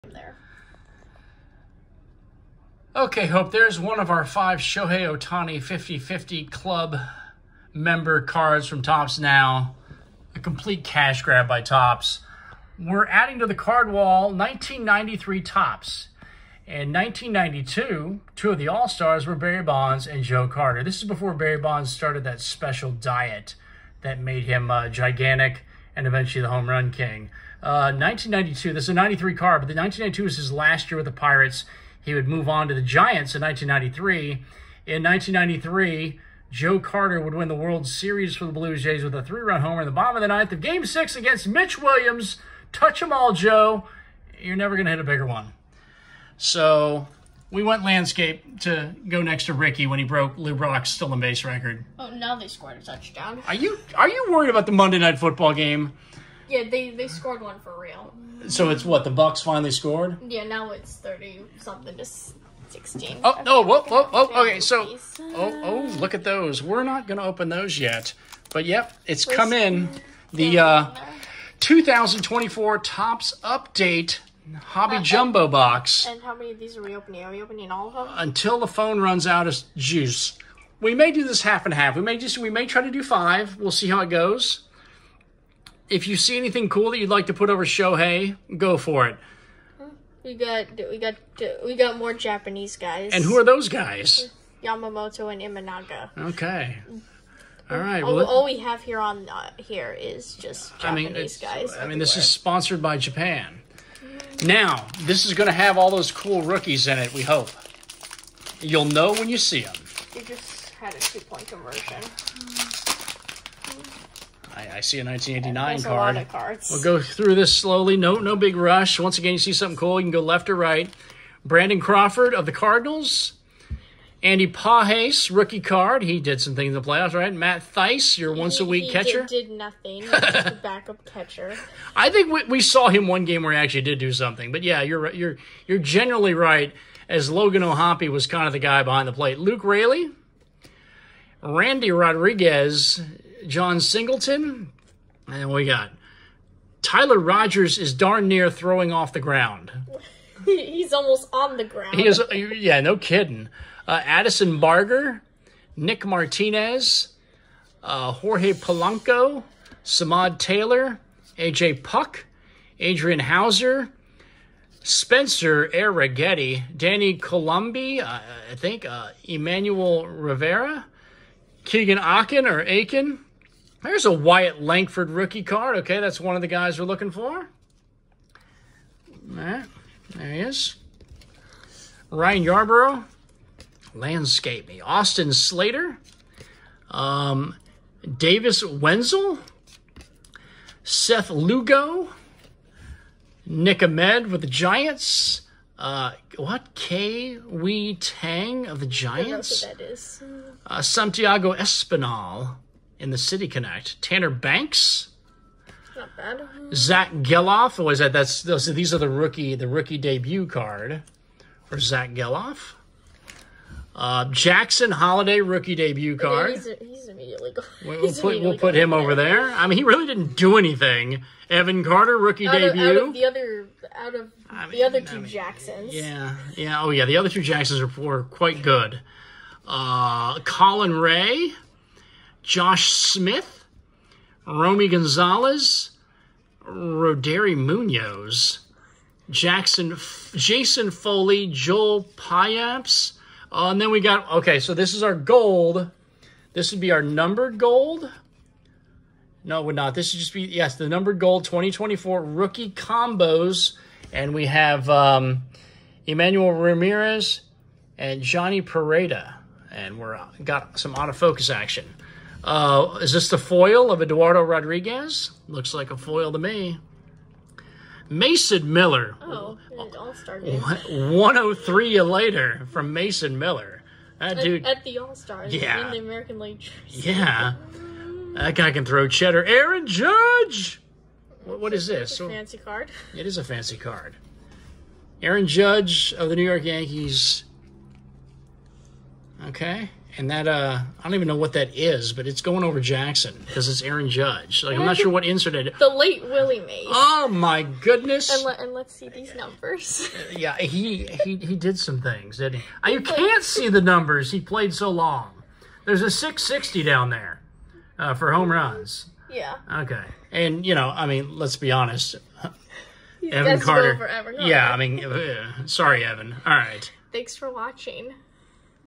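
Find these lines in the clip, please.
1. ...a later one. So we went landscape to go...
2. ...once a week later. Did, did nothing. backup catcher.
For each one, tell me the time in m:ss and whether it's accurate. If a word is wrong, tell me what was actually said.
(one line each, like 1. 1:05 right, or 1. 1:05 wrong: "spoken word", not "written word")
1. 0:44 wrong: "bigger", not "later"
2. 2:08 wrong: "catcher", not "later".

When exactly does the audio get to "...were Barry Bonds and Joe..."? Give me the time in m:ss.
0:19.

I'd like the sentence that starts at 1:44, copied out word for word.
Now, this is going to have all those cool rookies in it, we hope.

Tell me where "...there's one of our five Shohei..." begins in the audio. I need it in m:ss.
0:03.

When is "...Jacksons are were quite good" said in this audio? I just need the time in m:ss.
3:47.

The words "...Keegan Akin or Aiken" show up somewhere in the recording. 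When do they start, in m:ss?
2:51.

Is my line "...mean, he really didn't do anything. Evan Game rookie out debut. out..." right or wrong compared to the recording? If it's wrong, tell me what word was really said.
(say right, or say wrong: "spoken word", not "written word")
wrong: "Carter", not "Game".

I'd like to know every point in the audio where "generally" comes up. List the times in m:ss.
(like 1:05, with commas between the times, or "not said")
2:15.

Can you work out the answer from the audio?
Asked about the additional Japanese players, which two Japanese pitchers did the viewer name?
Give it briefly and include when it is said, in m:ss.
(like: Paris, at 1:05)
Yamamoto and Imanaga, at 1:34.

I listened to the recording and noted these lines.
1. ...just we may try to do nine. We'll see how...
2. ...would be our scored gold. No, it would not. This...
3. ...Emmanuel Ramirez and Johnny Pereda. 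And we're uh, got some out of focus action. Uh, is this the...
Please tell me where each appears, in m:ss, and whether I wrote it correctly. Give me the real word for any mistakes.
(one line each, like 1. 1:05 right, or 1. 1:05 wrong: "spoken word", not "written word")
1. 1:22 wrong: "five", not "nine"
2. 4:06 wrong: "numbered", not "scored"
3. 4:16 right.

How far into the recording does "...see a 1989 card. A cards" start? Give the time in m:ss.
1:54.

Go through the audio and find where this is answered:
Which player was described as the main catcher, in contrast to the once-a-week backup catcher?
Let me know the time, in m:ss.
2:17.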